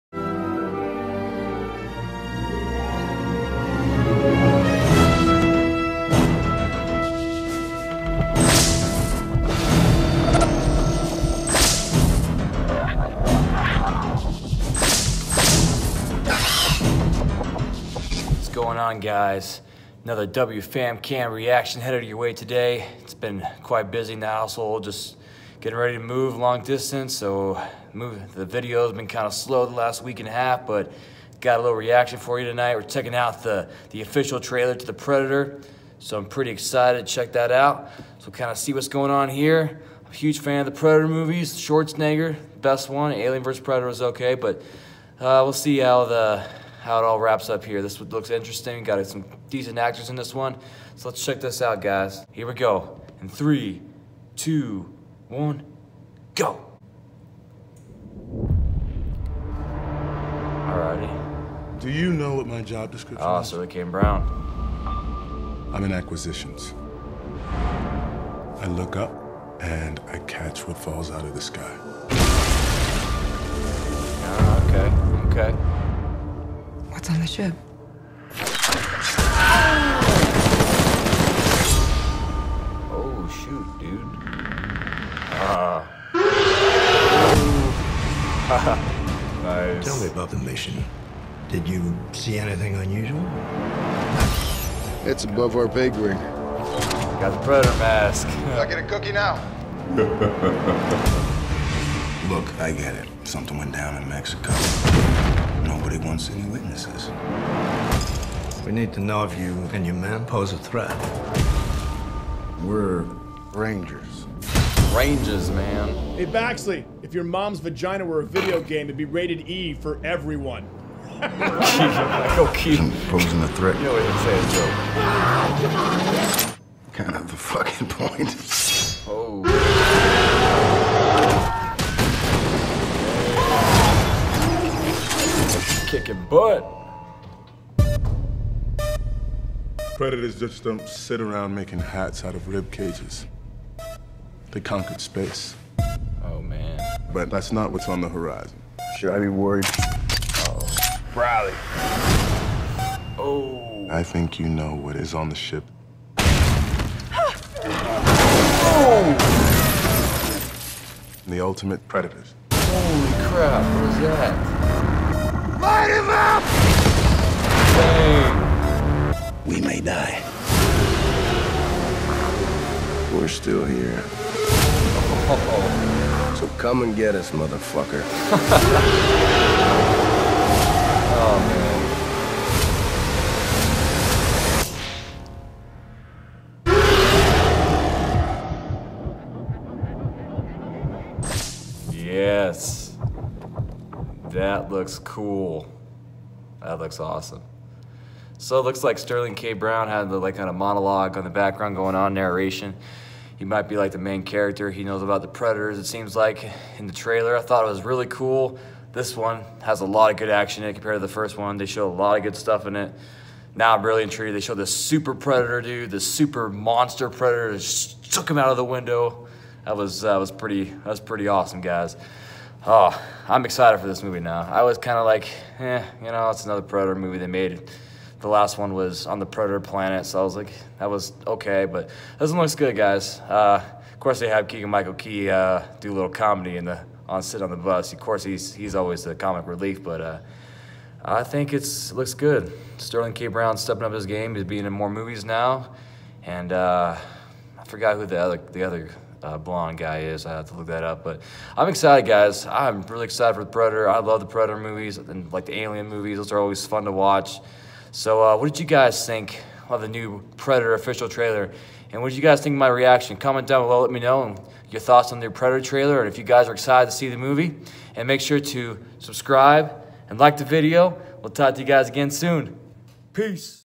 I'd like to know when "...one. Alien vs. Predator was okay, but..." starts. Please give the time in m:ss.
0:42.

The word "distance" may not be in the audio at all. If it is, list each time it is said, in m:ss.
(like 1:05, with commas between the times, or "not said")
0:26.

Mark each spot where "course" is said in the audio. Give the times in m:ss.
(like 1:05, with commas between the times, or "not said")
3:53, 3:57.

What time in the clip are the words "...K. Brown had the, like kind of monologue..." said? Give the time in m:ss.
3:19.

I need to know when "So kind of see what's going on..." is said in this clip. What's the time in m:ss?
0:38.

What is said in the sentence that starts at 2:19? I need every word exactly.
Predators just don't sit around making hats out of rib cages.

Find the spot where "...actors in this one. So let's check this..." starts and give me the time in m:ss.
0:49.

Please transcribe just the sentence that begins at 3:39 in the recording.
That was that was pretty that was pretty awesome, guys.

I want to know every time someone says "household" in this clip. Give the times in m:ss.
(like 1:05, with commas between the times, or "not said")
0:24.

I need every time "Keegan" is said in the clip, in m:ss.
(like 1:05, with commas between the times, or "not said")
3:54.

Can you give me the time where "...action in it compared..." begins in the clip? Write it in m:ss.
3:30.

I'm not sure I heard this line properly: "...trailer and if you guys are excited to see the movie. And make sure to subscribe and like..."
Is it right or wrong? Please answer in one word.
right.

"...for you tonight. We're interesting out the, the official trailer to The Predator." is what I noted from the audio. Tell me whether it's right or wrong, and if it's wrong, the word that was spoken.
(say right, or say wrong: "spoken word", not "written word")
wrong: "checking", not "interesting".